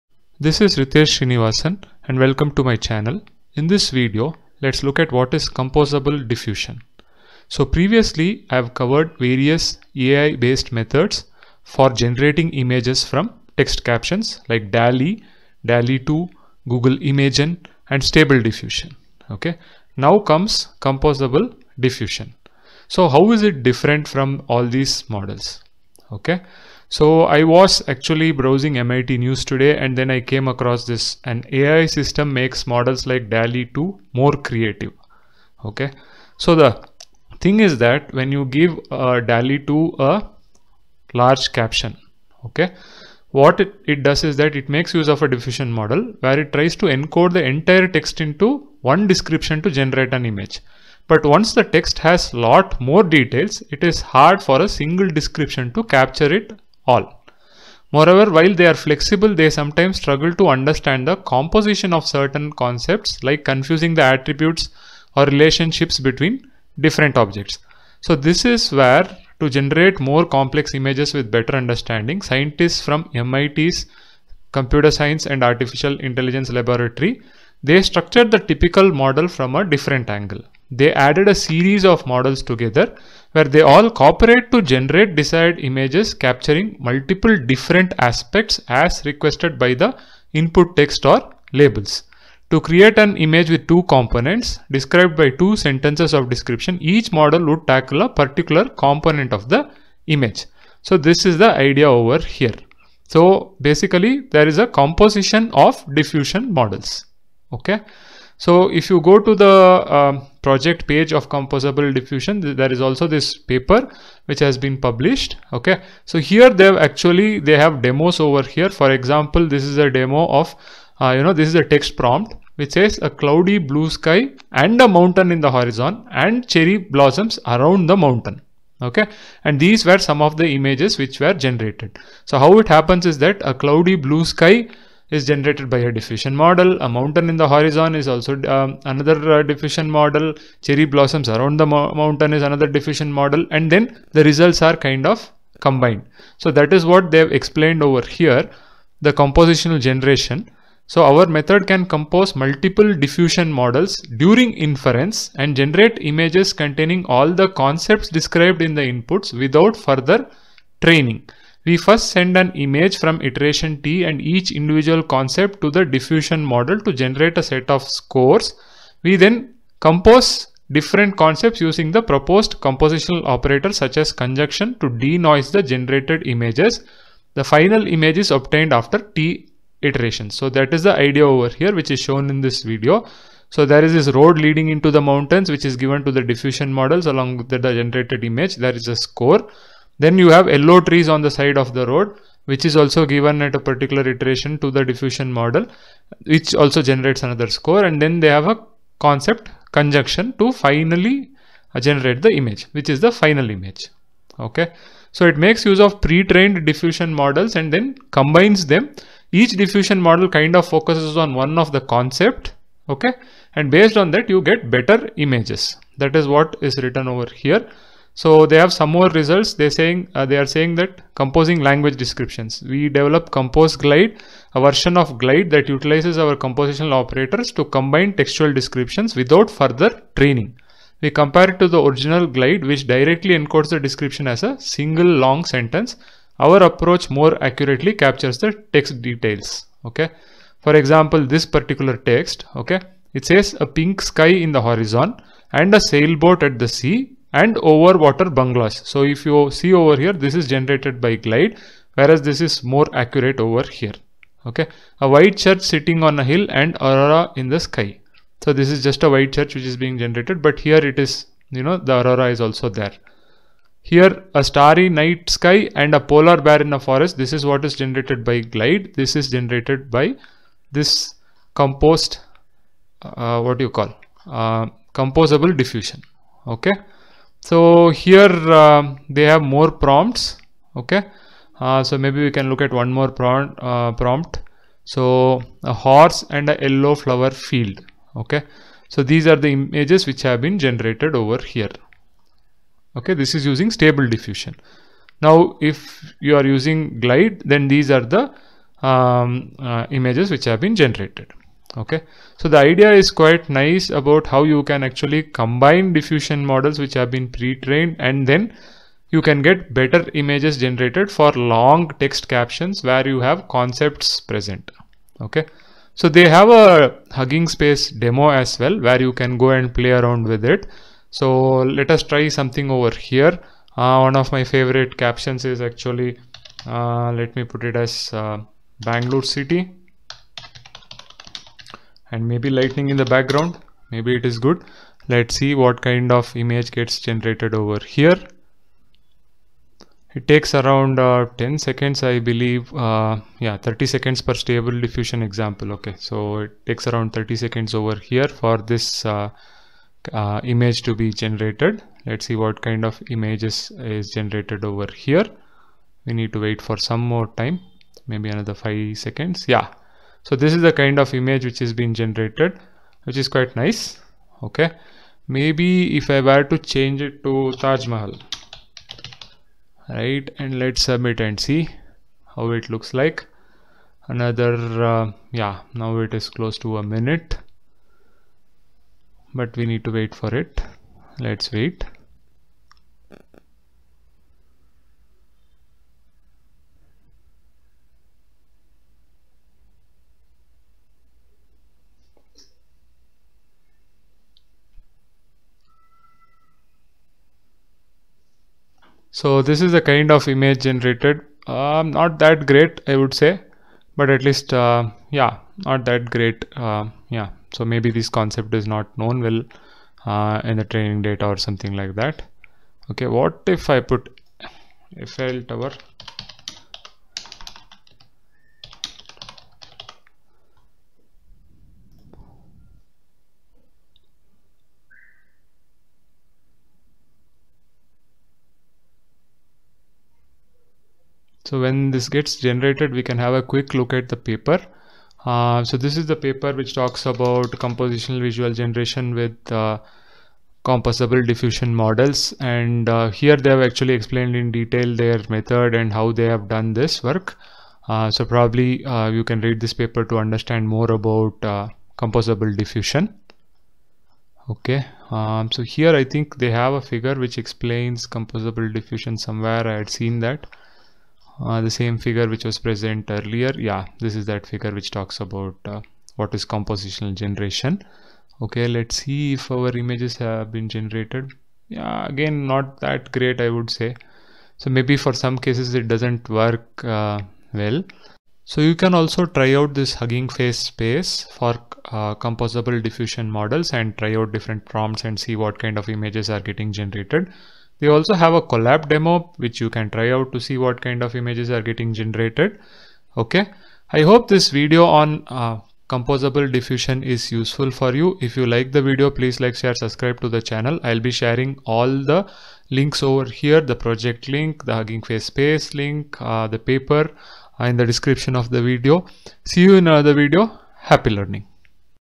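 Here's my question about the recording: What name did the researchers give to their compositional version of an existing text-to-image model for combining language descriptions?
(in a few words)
Compose Glide.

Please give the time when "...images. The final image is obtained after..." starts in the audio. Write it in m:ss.
2:56.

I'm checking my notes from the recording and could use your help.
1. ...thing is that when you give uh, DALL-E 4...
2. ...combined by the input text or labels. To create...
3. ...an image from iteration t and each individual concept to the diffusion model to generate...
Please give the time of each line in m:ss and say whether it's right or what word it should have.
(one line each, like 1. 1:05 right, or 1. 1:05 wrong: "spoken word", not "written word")
1. 0:37 wrong: "2", not "4"
2. 1:29 wrong: "requested", not "combined"
3. 2:42 right.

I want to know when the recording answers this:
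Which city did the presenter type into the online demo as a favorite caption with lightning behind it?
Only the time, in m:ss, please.
5:28.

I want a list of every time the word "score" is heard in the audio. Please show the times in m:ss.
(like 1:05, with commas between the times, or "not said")
2:47, 3:08, 3:17.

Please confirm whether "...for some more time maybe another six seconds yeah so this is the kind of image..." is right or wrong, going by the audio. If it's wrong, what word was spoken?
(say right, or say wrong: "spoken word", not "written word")
wrong: "five", not "six".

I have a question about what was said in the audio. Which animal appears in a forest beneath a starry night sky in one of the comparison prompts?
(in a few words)
Polar bear.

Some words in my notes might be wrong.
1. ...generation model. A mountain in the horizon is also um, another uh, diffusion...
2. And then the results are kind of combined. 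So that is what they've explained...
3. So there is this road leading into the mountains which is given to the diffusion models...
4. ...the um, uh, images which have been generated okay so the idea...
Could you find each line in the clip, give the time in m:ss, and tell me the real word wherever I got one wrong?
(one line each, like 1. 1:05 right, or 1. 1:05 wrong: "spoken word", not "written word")
1. 2:15 wrong: "diffusion", not "generation"
2. 2:23 right
3. 3:03 right
4. 4:58 right.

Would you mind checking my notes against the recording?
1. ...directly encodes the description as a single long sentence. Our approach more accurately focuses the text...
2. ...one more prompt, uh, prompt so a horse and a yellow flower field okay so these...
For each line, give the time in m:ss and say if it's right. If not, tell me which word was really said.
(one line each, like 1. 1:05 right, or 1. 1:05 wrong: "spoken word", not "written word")
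1. 3:52 wrong: "captures", not "focuses"
2. 4:42 right.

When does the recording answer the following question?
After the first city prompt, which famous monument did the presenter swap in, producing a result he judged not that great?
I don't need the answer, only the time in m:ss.
6:07.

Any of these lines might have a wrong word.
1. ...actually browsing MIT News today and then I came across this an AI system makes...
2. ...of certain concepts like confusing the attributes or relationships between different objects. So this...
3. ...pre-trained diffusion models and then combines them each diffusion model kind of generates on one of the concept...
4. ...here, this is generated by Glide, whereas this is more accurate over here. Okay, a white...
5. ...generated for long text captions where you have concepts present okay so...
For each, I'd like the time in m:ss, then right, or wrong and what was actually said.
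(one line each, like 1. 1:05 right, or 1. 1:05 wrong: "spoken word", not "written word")
1. 0:27 right
2. 1:01 right
3. 3:26 wrong: "focuses", not "generates"
4. 4:09 right
5. 5:10 right.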